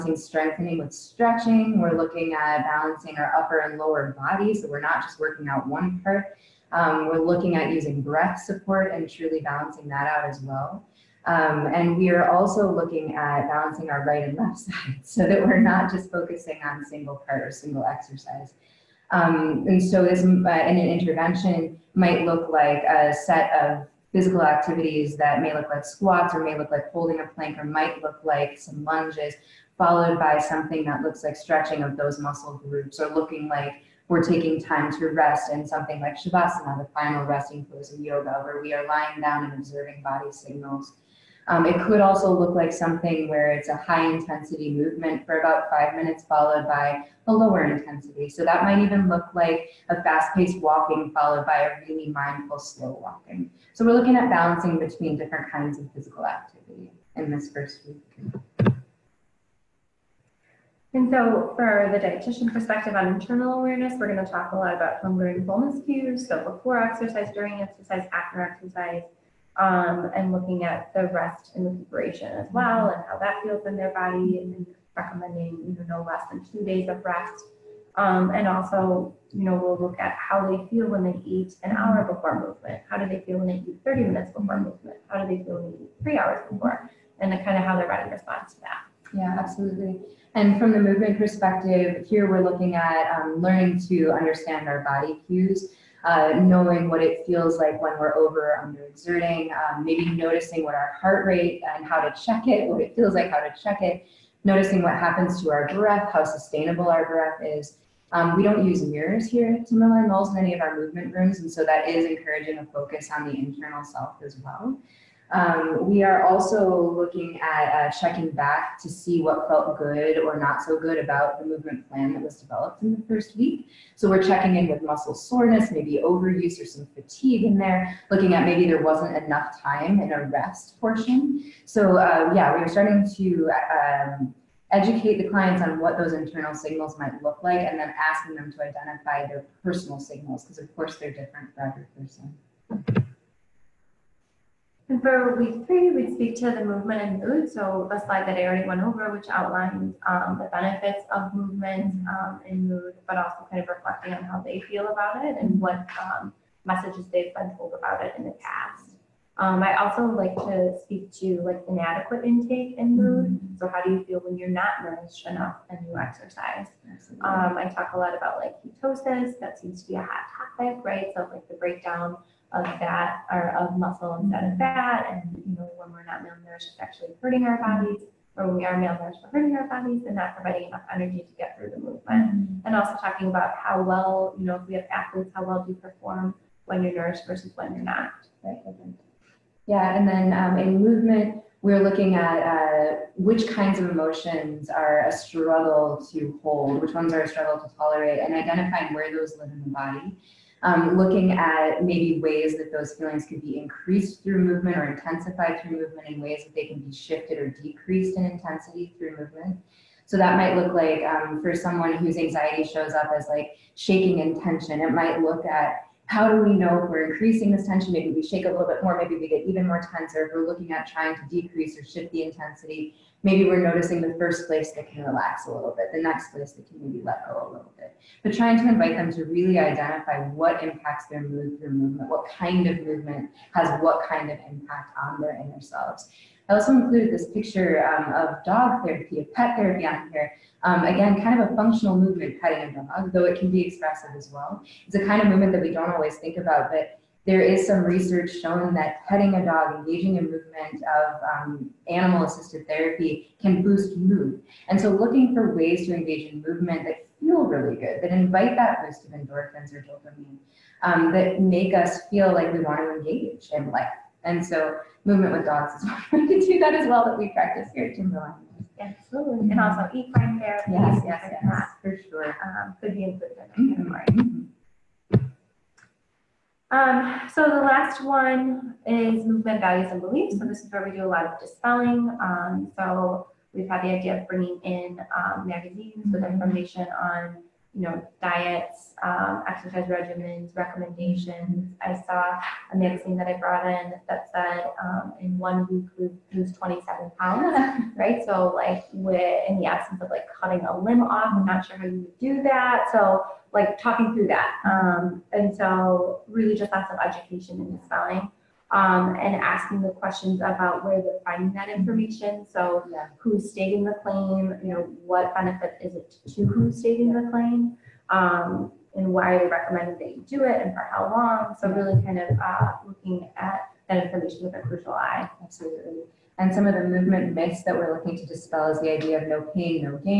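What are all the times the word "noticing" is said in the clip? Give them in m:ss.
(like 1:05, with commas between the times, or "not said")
1:40, 1:44, 3:43.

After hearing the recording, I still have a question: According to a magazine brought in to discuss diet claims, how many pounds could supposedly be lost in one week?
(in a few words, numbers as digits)
27.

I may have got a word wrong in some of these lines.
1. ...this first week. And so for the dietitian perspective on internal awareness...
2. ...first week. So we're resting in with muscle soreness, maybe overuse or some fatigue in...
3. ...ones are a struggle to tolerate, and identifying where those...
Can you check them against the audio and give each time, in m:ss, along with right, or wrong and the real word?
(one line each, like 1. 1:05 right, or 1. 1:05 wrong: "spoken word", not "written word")
1. 0:57 right
2. 2:03 wrong: "checking", not "resting"
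3. 3:16 right.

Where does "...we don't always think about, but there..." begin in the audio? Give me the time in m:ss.
4:05.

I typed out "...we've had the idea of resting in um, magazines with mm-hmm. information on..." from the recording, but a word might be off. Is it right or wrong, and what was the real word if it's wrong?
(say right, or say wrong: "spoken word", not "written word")
wrong: "bringing", not "resting".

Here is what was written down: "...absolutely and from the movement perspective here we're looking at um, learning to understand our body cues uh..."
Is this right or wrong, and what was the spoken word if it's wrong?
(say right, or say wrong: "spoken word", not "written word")
right.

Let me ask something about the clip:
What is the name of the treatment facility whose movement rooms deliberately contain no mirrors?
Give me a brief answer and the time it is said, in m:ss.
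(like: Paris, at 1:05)
Timberline Knolls, at 1:49.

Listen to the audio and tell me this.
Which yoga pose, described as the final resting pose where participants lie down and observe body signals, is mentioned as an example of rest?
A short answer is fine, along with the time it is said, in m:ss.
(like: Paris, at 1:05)
Shavasana, at 0:36.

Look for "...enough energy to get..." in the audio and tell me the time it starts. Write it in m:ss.
3:00.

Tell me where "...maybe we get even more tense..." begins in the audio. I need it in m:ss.
3:38.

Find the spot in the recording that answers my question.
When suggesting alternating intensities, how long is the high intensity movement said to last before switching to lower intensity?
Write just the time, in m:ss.
0:45.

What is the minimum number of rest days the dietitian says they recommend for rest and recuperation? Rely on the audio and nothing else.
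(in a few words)
2.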